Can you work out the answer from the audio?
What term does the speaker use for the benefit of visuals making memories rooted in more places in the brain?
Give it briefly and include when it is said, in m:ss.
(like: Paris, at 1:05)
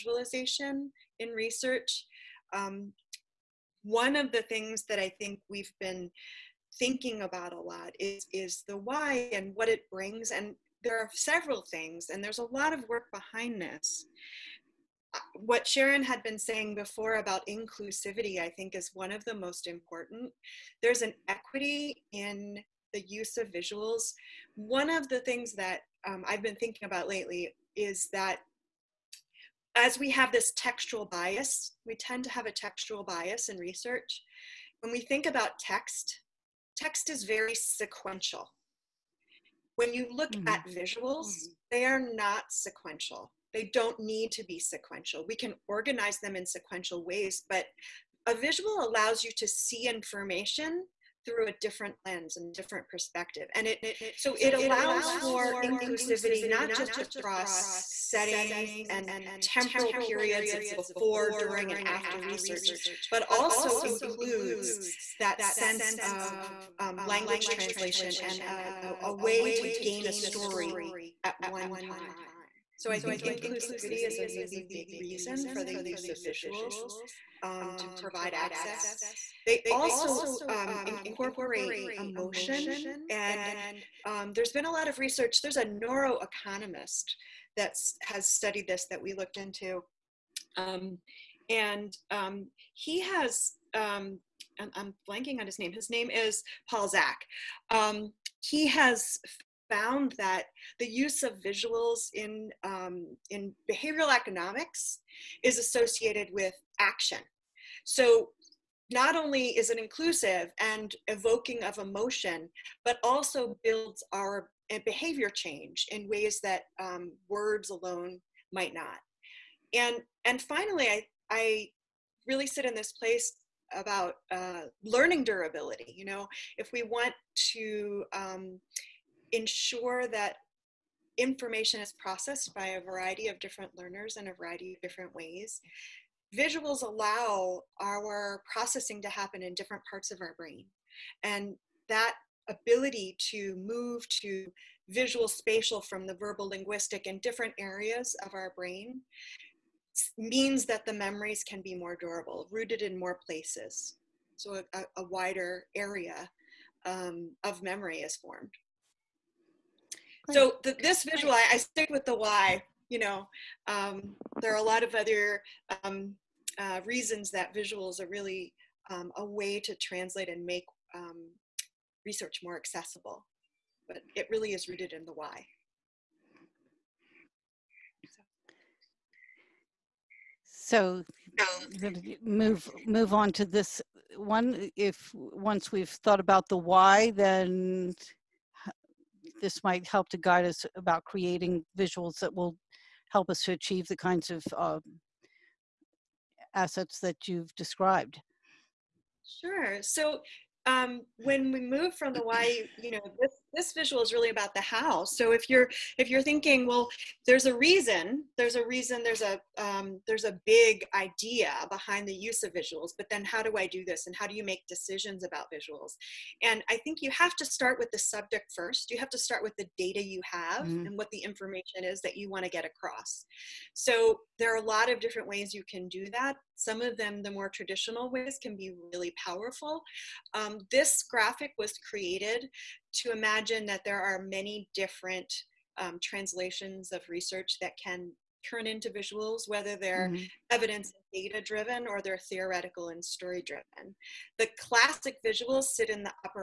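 learning durability, at 2:04.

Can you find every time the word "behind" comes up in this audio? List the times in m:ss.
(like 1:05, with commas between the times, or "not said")
0:13, 3:31.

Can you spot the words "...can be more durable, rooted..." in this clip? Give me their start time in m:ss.
2:31.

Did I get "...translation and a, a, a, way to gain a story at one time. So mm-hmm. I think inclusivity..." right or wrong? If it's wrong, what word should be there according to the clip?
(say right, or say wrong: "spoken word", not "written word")
right.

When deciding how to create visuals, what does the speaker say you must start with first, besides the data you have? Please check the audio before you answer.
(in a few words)
the subject.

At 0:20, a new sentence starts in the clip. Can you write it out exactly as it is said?
There's an equity in the use of visuals.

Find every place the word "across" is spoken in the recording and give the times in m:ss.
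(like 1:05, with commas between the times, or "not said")
0:57, 3:42.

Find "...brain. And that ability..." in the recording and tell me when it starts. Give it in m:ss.
2:20.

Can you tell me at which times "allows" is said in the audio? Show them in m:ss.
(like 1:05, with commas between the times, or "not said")
0:48, 0:54, 2:16.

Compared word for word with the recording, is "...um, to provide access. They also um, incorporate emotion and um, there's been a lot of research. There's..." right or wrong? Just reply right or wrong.
right.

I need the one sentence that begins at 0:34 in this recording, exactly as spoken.
When we think about text, text is very sequential.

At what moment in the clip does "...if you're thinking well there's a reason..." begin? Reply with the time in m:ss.
3:25.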